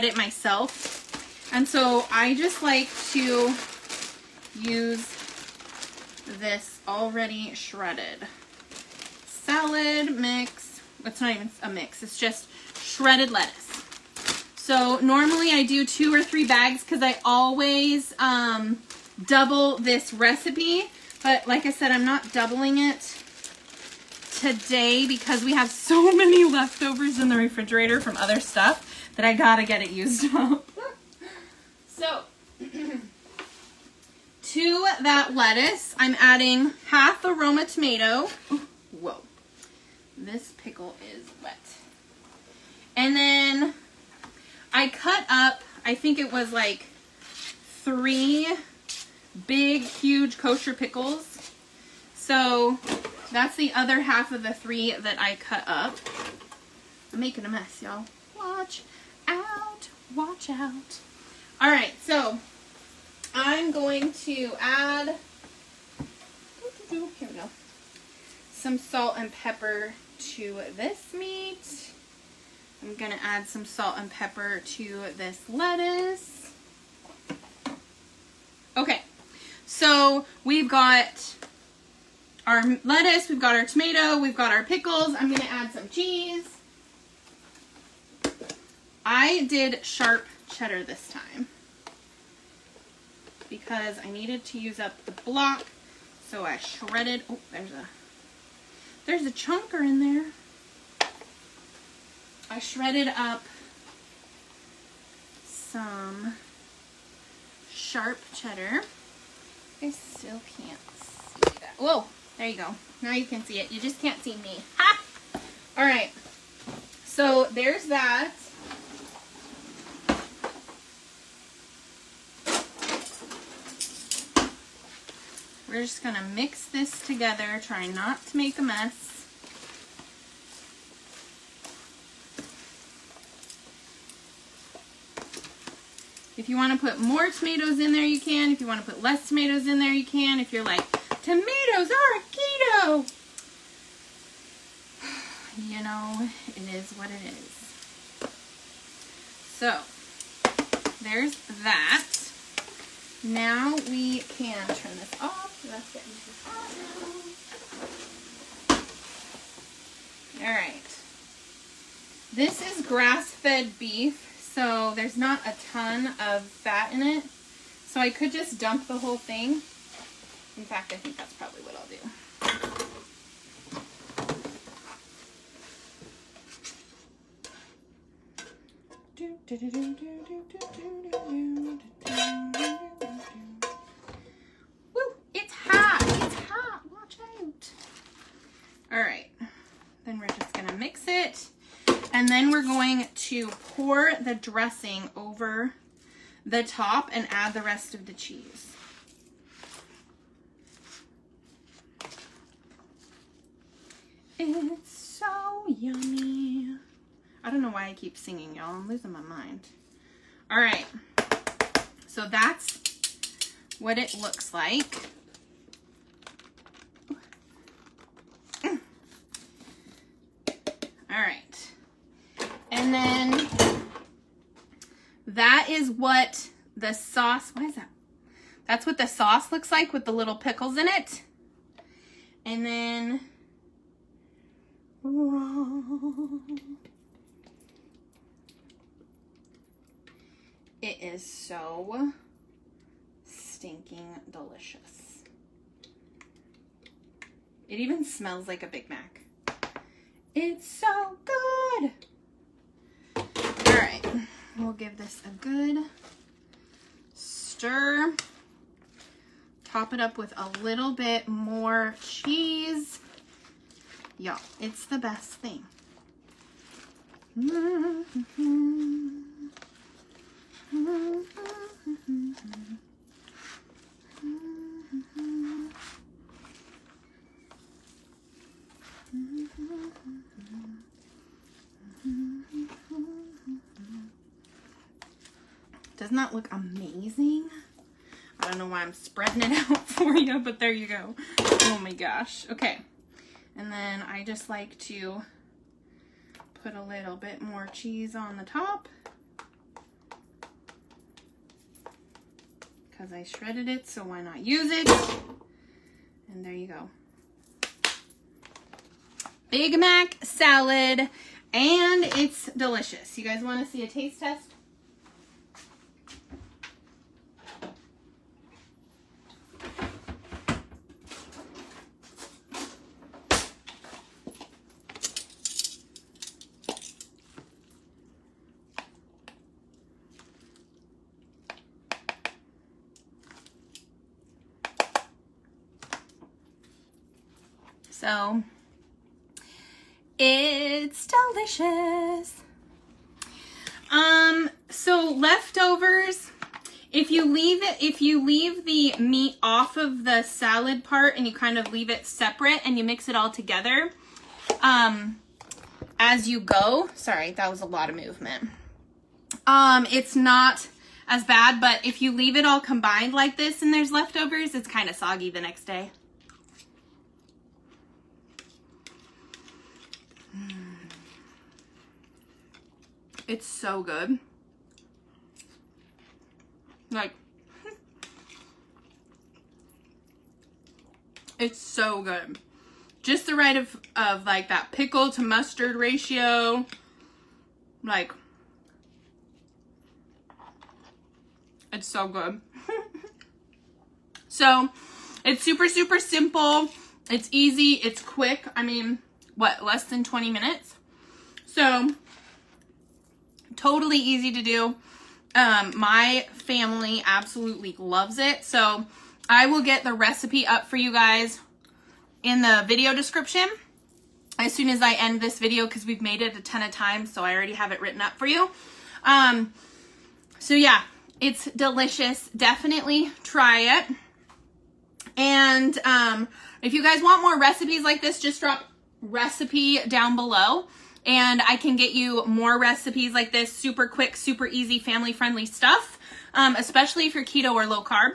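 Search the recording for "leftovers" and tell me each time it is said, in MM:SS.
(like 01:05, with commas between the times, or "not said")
00:26, 05:45, 06:03.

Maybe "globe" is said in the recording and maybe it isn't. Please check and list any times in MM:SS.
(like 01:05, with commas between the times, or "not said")
not said.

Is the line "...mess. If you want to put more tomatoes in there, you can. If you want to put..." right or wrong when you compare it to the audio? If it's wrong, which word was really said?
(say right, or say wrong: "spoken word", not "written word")
right.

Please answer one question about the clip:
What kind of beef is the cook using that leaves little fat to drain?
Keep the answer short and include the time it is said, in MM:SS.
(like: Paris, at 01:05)
grass-fed, at 02:42.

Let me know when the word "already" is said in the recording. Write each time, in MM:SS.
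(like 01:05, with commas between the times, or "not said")
00:06, 06:57.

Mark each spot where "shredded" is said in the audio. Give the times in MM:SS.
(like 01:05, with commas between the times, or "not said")
00:07, 00:12, 01:36, 01:42, 05:03.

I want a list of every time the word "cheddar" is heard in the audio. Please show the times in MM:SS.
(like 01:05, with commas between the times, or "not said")
01:30, 01:48.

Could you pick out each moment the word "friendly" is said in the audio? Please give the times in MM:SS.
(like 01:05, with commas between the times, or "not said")
07:14.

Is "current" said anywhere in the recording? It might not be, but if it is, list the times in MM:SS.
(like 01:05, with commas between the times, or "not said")
not said.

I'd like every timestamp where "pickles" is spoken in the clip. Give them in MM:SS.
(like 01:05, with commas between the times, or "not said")
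00:40, 00:50, 01:24, 03:50, 06:24.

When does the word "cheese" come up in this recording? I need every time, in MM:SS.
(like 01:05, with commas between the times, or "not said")
01:25, 03:18, 04:22, 04:57.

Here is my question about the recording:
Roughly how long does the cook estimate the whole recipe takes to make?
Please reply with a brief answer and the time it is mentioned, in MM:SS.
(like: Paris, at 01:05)
less than 20 minutes, at 06:39.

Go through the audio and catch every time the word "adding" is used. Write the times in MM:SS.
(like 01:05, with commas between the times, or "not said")
00:36.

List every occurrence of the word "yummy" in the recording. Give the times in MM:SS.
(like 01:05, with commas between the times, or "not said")
03:25.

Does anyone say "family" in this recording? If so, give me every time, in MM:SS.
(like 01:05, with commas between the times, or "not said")
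06:46, 07:14.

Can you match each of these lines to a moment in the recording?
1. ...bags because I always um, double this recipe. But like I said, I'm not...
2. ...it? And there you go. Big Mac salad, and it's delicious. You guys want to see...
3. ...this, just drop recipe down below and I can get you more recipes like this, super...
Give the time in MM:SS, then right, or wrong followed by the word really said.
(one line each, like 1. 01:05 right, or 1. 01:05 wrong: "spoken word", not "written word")
1. 00:16 right
2. 05:04 right
3. 07:08 right.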